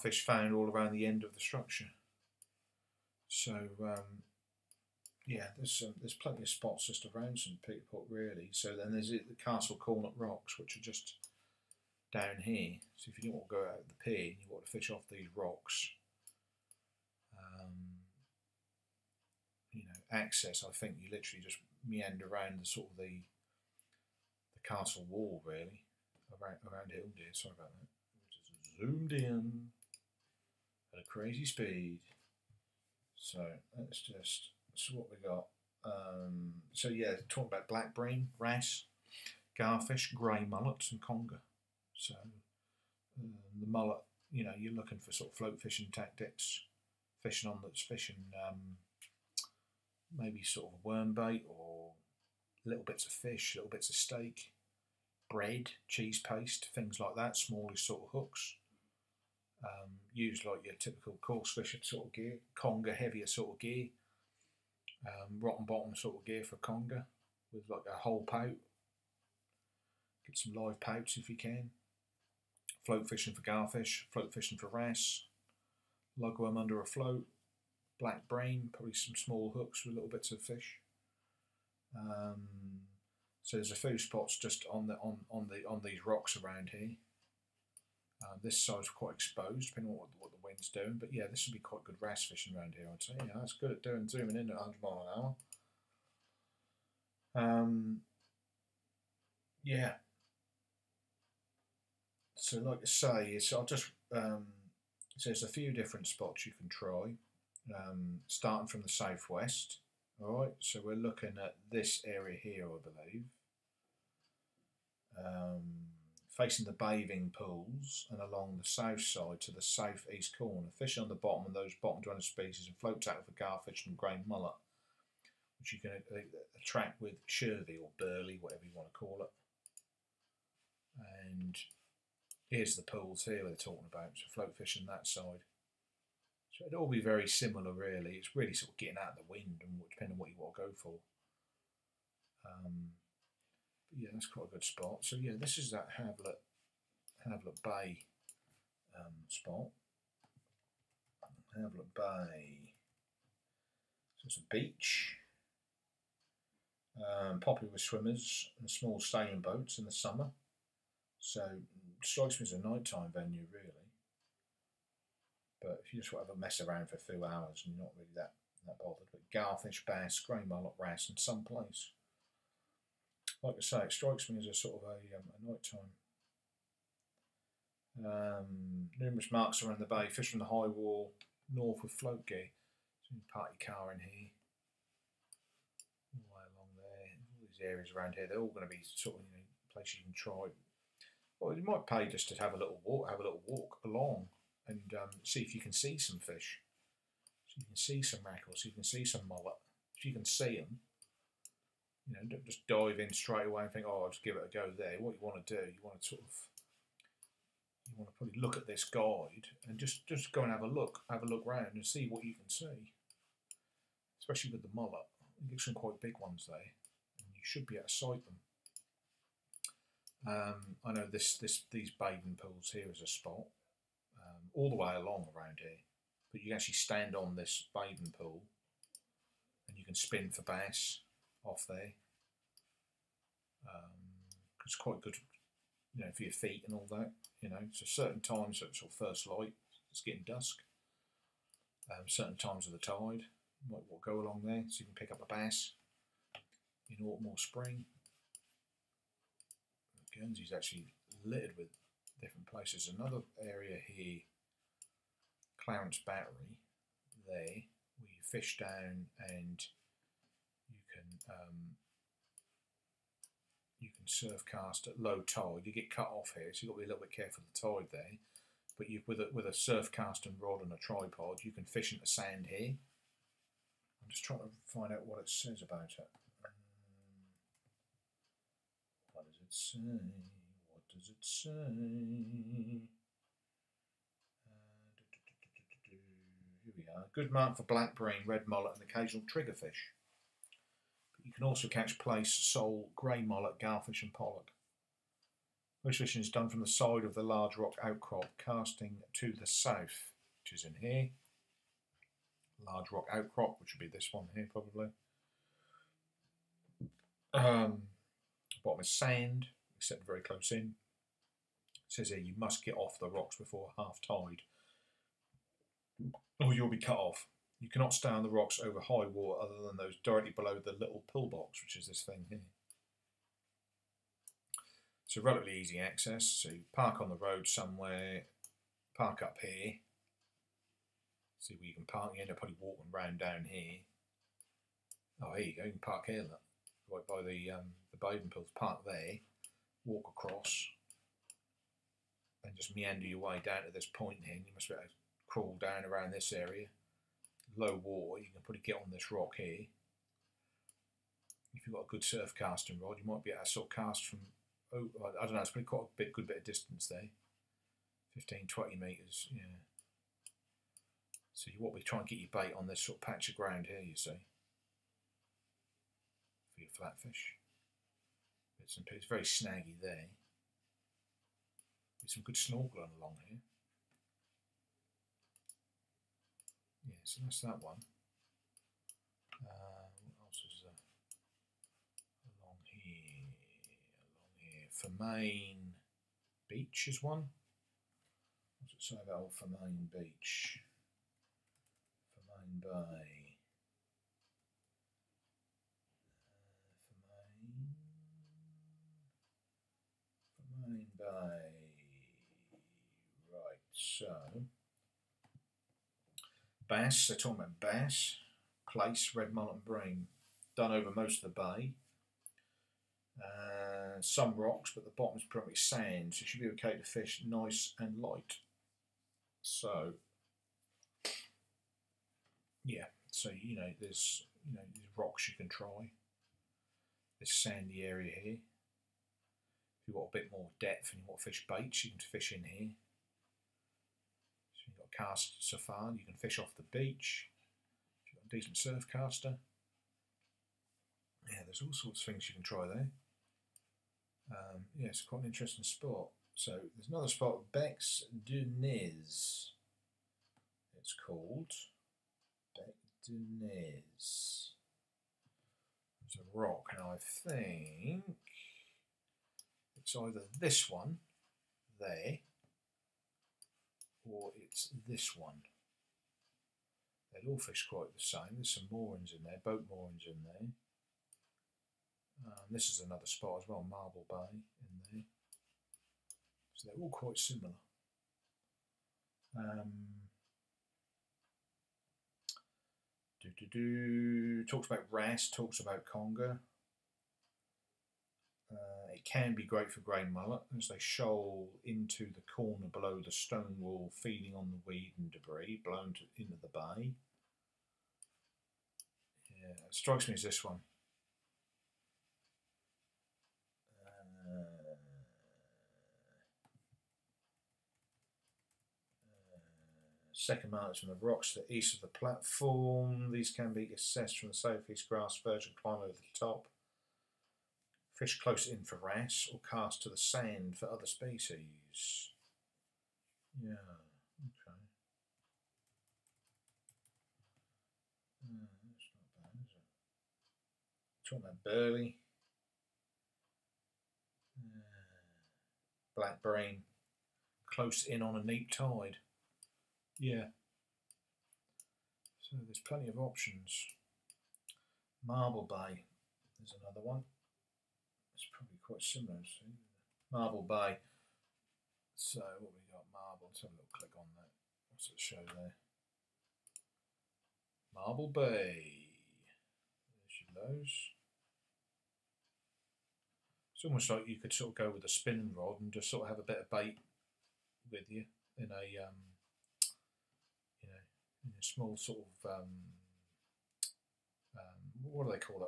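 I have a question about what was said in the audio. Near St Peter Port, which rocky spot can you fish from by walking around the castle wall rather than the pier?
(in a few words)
Castle Cornet Rocks.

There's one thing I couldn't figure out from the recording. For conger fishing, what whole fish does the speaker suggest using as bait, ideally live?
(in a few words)
pout.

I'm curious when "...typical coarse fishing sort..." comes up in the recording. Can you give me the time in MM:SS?
01:00.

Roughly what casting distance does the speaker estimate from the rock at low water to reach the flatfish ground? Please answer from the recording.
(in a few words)
15 to 20 metres.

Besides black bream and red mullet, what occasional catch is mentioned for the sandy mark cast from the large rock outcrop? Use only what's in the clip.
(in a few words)
triggerfish.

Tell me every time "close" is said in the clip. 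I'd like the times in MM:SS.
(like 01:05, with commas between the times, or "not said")
05:10, 08:38, 08:57.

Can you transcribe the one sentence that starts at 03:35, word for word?
You get some quite big ones there.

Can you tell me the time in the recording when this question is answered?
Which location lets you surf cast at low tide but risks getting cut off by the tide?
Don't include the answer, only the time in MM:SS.
04:15.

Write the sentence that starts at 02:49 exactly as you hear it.
But Garfish, bass, grey mullet, Rouse, and someplace.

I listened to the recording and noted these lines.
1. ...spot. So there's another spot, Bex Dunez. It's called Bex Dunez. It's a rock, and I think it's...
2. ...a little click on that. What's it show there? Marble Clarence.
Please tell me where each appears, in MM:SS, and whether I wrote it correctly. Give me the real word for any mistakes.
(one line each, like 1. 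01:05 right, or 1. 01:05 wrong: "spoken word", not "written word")
1. 07:25 right
2. 09:13 wrong: "Bay", not "Clarence".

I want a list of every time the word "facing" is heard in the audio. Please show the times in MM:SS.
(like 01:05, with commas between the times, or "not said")
01:56.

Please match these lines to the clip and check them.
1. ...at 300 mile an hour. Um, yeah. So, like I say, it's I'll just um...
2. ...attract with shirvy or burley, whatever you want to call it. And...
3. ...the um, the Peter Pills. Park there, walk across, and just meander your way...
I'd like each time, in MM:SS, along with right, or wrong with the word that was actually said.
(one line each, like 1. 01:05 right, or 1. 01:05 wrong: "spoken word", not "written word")
1. 01:34 wrong: "100", not "300"
2. 02:06 right
3. 05:37 wrong: "Bowden", not "Peter".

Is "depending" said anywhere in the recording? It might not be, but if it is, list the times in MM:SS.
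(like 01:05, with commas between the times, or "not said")
01:29, 02:19.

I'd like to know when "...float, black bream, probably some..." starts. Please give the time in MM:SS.
01:16.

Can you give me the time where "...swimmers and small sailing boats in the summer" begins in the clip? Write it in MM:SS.
02:37.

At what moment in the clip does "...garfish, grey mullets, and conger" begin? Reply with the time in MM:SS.
00:39.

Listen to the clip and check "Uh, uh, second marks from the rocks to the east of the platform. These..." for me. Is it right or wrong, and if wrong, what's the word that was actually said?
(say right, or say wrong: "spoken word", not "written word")
right.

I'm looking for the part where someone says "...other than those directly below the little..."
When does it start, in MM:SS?
05:19.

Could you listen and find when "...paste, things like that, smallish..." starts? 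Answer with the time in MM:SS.
00:56.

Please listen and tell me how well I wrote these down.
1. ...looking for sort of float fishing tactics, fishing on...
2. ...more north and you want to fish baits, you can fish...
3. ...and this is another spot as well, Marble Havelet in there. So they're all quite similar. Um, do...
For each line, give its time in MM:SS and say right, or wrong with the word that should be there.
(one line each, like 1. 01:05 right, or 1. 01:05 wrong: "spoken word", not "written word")
1. 00:44 right
2. 07:10 wrong: "depth", not "north"
3. 07:52 wrong: "Bay", not "Havelet".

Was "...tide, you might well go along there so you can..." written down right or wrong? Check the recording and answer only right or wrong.
right.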